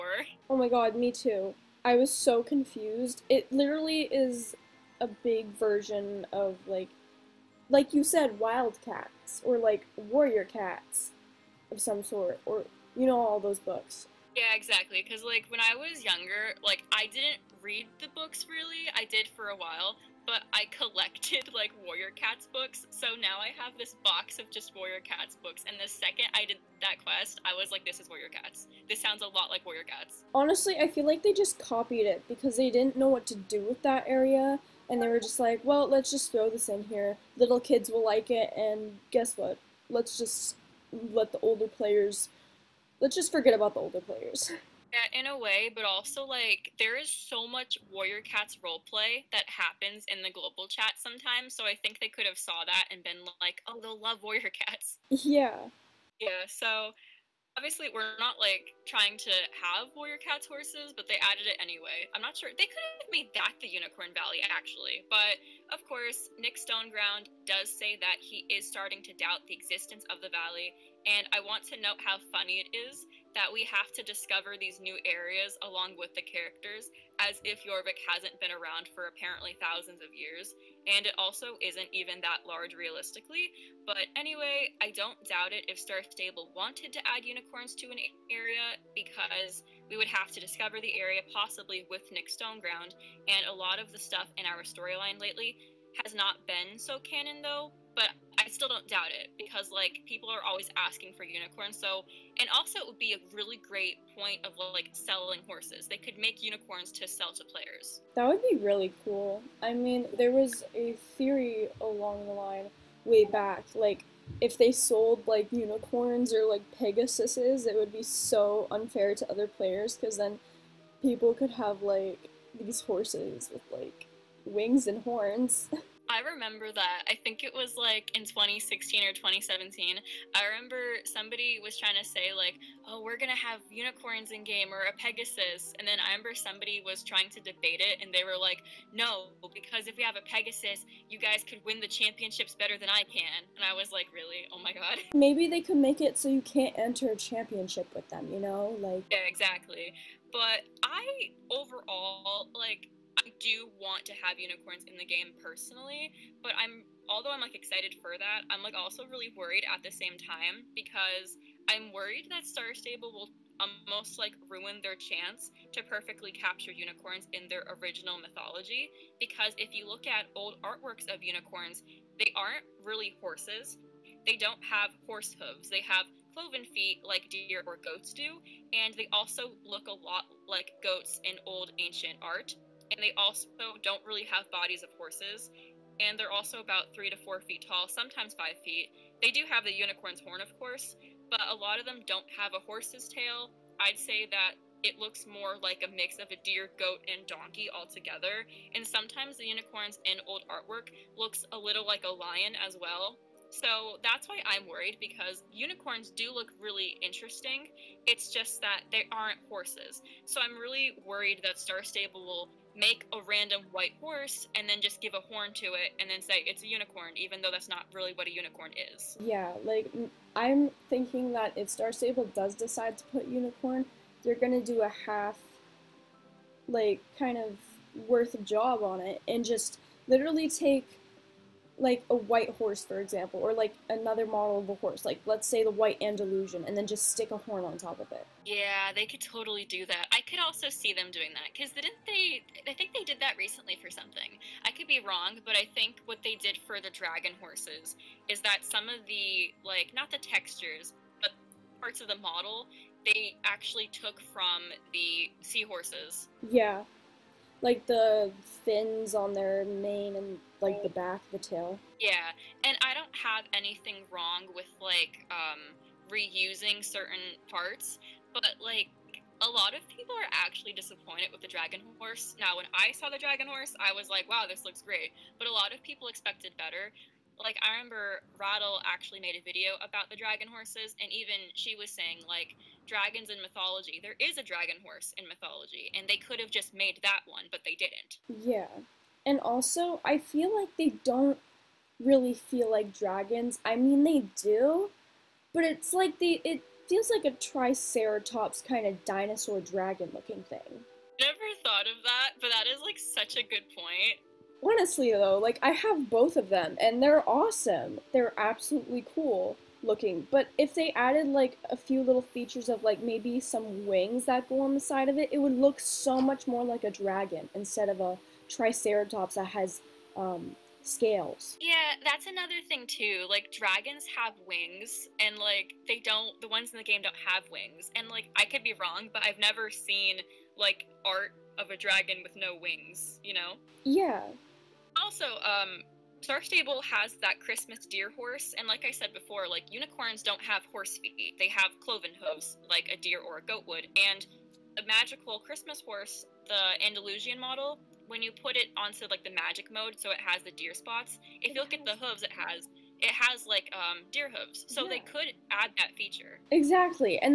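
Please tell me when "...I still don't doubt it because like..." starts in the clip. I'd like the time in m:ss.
1:38.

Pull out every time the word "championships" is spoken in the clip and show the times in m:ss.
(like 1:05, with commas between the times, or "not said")
2:21, 2:27.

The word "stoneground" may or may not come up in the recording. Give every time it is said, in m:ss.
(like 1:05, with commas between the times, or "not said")
1:06, 1:32.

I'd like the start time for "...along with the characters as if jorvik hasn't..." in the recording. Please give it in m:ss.
1:15.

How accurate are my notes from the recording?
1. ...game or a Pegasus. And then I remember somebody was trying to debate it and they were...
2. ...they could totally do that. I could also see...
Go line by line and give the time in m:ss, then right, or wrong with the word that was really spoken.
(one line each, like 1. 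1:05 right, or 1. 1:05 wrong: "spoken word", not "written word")
1. 2:14 right
2. 3:58 right.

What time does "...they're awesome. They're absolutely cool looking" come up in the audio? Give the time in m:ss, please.
5:07.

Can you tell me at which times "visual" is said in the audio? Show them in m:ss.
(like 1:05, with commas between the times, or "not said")
not said.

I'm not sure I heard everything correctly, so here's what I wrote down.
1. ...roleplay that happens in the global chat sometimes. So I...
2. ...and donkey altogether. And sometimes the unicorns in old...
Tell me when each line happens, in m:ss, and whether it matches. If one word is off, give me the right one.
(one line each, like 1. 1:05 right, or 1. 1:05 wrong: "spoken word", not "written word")
1. 0:48 right
2. 3:17 right.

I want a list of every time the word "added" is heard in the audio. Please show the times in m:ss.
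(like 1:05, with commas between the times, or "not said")
1:01, 5:10.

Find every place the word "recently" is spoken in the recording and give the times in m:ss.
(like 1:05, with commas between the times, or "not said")
4:03.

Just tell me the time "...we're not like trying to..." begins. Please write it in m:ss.
0:57.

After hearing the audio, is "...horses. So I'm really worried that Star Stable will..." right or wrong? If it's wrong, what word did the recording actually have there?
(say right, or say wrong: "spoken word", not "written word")
right.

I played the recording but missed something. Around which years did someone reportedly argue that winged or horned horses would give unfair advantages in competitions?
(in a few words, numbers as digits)
2016 or 2017.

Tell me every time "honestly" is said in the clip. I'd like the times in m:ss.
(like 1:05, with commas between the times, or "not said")
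0:30, 5:04.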